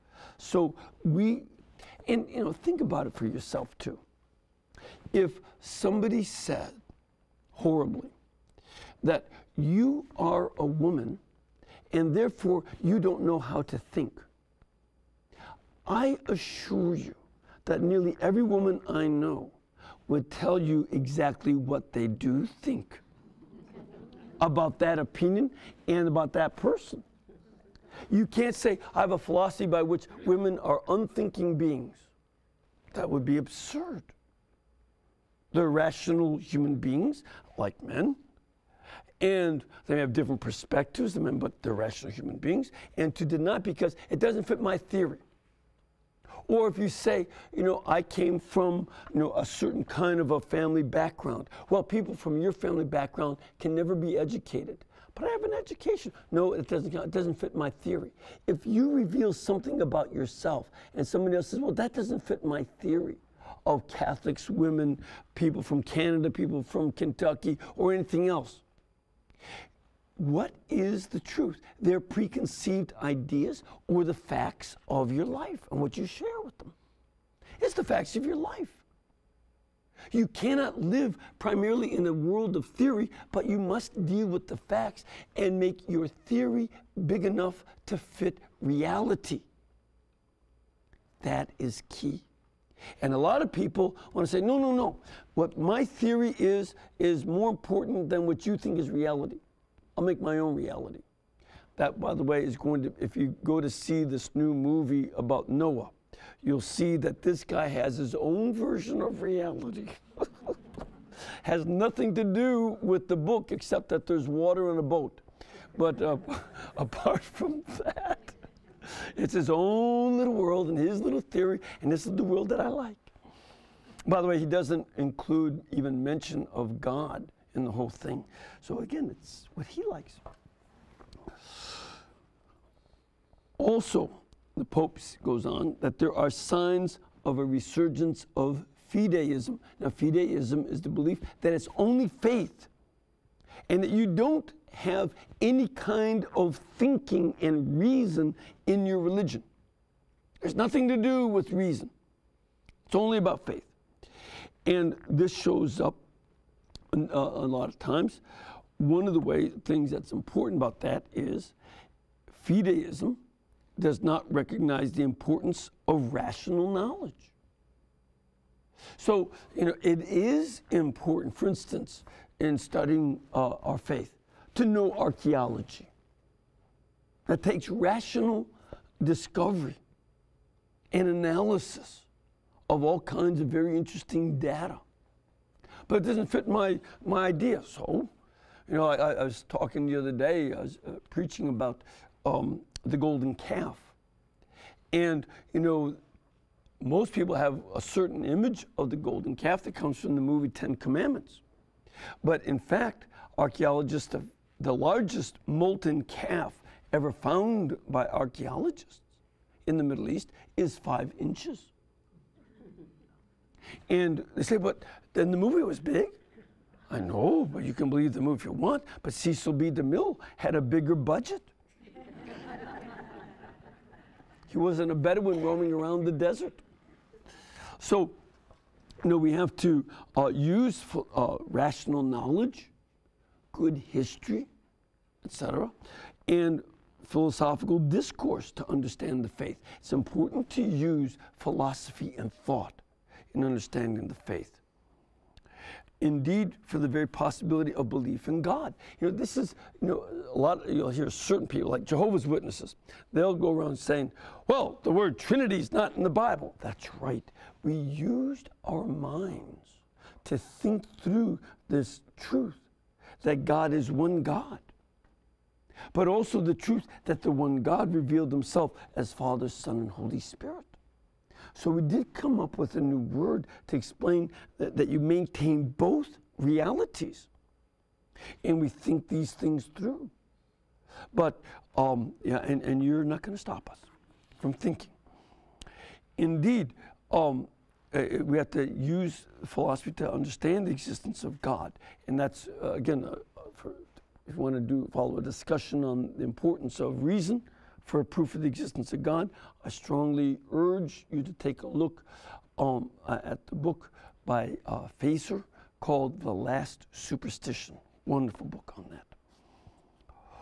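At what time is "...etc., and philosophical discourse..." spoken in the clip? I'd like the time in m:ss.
3:55.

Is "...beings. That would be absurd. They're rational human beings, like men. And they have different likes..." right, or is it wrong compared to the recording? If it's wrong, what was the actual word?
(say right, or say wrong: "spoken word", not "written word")
wrong: "perspectives", not "likes".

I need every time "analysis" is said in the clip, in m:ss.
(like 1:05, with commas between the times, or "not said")
3:01.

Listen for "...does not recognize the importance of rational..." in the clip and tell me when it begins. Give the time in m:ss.
2:43.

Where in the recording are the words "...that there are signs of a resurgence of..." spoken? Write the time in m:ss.
2:15.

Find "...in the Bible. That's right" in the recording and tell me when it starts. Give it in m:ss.
4:15.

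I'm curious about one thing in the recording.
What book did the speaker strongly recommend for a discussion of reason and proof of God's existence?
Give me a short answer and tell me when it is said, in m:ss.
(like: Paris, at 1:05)
The Last Superstition, at 5:06.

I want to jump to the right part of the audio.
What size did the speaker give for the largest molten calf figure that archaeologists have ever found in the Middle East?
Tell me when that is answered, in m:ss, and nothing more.
3:30.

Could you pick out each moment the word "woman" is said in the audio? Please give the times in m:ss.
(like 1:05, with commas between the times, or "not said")
0:10, 0:18.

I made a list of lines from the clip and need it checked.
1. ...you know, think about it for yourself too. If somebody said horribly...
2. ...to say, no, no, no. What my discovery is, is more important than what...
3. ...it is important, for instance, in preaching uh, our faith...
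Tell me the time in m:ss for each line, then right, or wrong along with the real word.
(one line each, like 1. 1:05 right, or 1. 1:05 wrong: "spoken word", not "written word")
1. 0:02 right
2. 1:34 wrong: "theory", not "discovery"
3. 2:49 wrong: "studying", not "preaching".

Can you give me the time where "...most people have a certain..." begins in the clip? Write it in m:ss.
3:16.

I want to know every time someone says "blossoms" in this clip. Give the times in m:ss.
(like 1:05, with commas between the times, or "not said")
not said.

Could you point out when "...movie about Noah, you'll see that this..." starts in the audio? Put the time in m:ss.
1:44.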